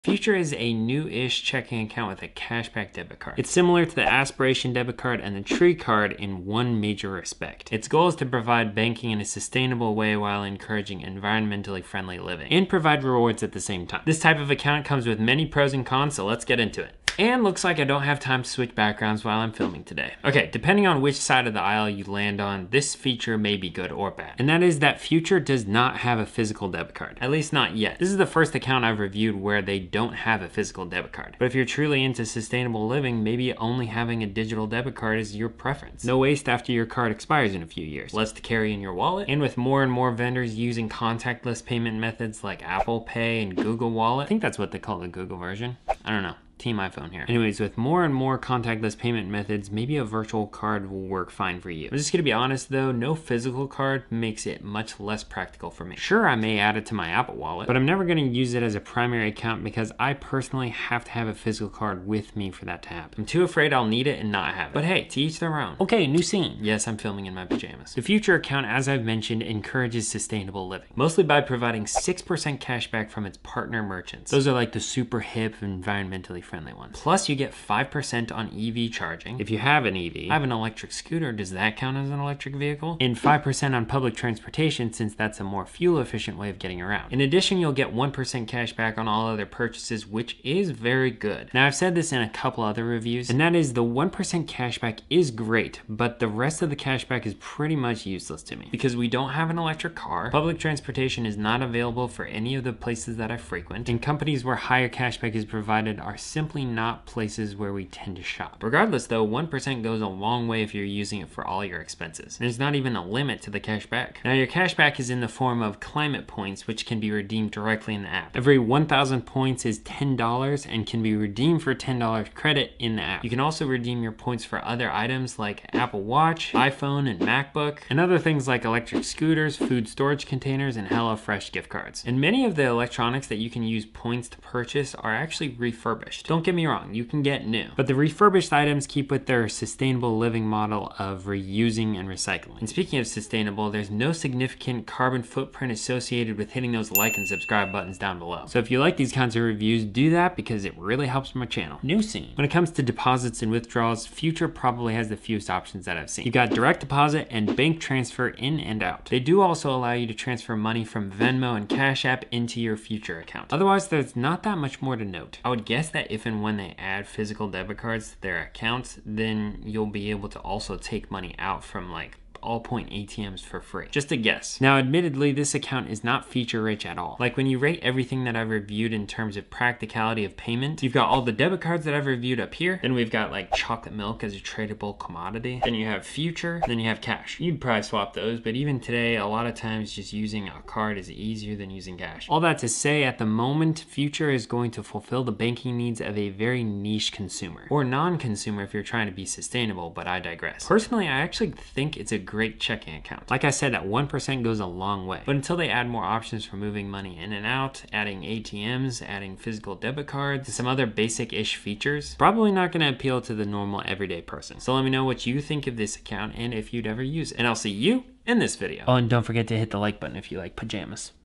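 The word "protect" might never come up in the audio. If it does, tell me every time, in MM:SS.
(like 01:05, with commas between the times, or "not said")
not said.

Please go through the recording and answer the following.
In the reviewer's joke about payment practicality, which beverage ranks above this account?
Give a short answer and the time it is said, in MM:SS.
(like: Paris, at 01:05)
chocolate milk, at 03:03.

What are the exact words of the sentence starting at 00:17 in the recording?
And looks like I don't have time to switch backgrounds while I'm filming today.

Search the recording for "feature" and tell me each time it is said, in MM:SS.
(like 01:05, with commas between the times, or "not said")
00:22, 02:56, 03:31.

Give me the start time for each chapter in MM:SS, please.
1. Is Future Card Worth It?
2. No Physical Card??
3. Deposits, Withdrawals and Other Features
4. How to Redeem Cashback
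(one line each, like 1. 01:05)
1. 03:12
2. 00:20
3. 02:32
4. 01:54.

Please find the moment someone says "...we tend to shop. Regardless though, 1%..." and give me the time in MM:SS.
01:47.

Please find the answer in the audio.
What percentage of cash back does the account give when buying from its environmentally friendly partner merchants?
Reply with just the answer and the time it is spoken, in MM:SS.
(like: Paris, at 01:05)
6%, at 01:11.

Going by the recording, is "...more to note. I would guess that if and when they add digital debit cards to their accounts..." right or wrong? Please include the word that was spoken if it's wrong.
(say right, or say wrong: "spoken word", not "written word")
wrong: "physical", not "digital".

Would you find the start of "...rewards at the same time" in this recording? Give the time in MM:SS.
00:13.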